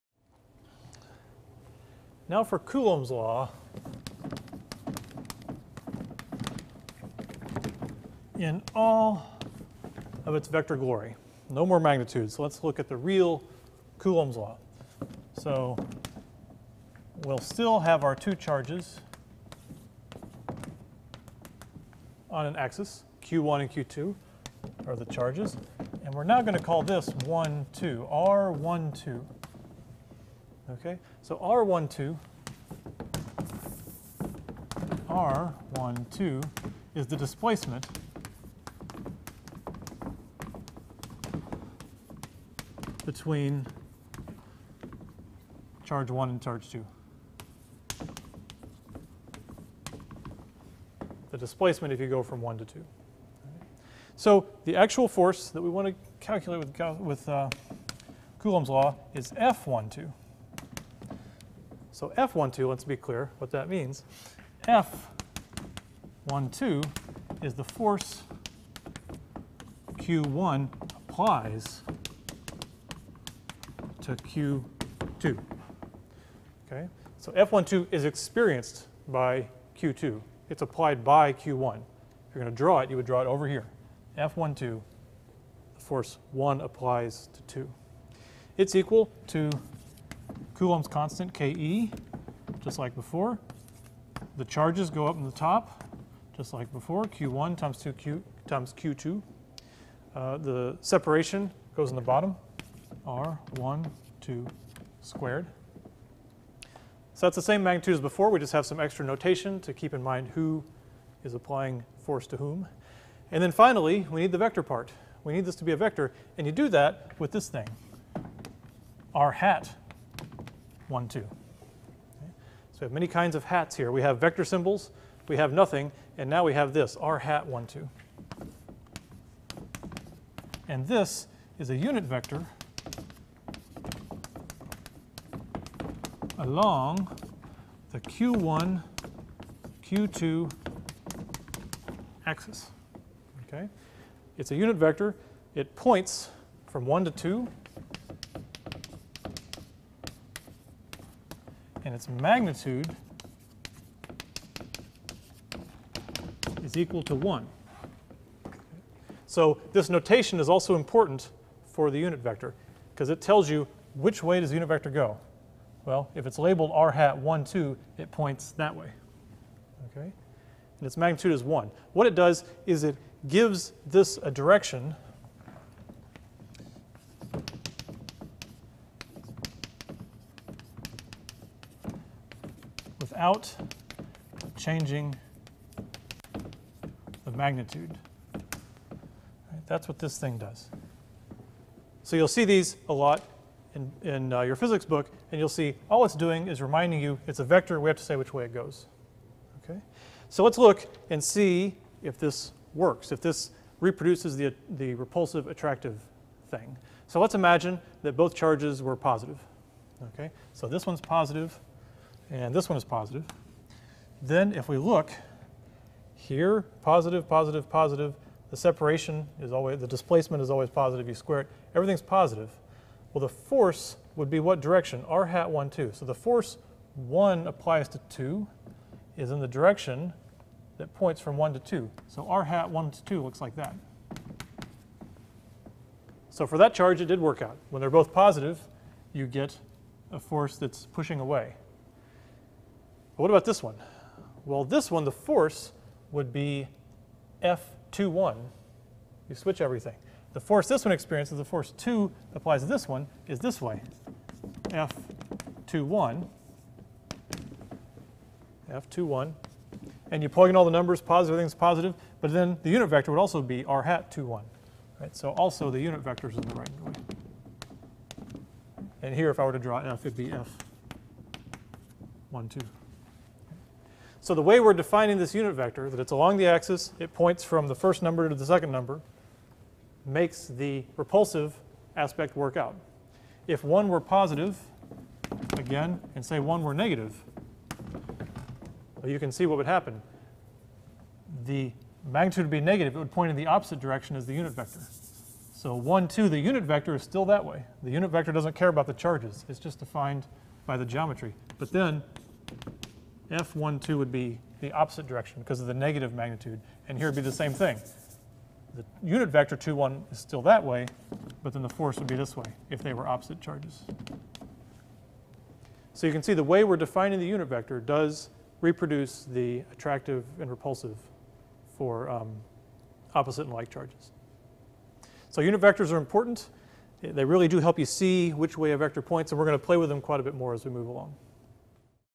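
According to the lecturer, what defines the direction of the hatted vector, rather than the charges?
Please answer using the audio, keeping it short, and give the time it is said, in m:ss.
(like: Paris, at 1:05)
the geometry, at 4:59.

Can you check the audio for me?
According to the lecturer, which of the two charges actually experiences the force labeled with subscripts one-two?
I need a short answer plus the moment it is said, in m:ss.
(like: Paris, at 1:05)
Q2, at 1:17.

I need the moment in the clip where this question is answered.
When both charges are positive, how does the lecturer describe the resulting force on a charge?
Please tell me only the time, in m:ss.
3:59.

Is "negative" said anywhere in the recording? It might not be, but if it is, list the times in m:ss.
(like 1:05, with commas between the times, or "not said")
4:46, 4:52, 5:05.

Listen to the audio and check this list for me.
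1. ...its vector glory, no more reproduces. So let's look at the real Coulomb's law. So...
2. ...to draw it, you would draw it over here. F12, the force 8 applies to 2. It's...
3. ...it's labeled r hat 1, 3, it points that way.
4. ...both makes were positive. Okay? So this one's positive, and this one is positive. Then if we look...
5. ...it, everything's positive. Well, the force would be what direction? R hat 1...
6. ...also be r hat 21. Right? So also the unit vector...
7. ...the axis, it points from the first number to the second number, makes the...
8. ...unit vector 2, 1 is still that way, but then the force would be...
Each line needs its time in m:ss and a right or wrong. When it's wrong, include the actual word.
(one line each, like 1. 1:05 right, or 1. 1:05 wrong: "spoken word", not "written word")
1. 0:10 wrong: "magnitudes", not "reproduces"
2. 1:22 wrong: "1", not "8"
3. 2:46 wrong: "2", not "3"
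4. 3:28 wrong: "charges", not "makes"
5. 3:41 right
6. 4:23 right
7. 4:36 right
8. 5:09 right.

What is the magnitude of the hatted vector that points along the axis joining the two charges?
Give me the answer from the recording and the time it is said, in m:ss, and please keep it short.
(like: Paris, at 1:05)
1, at 2:31.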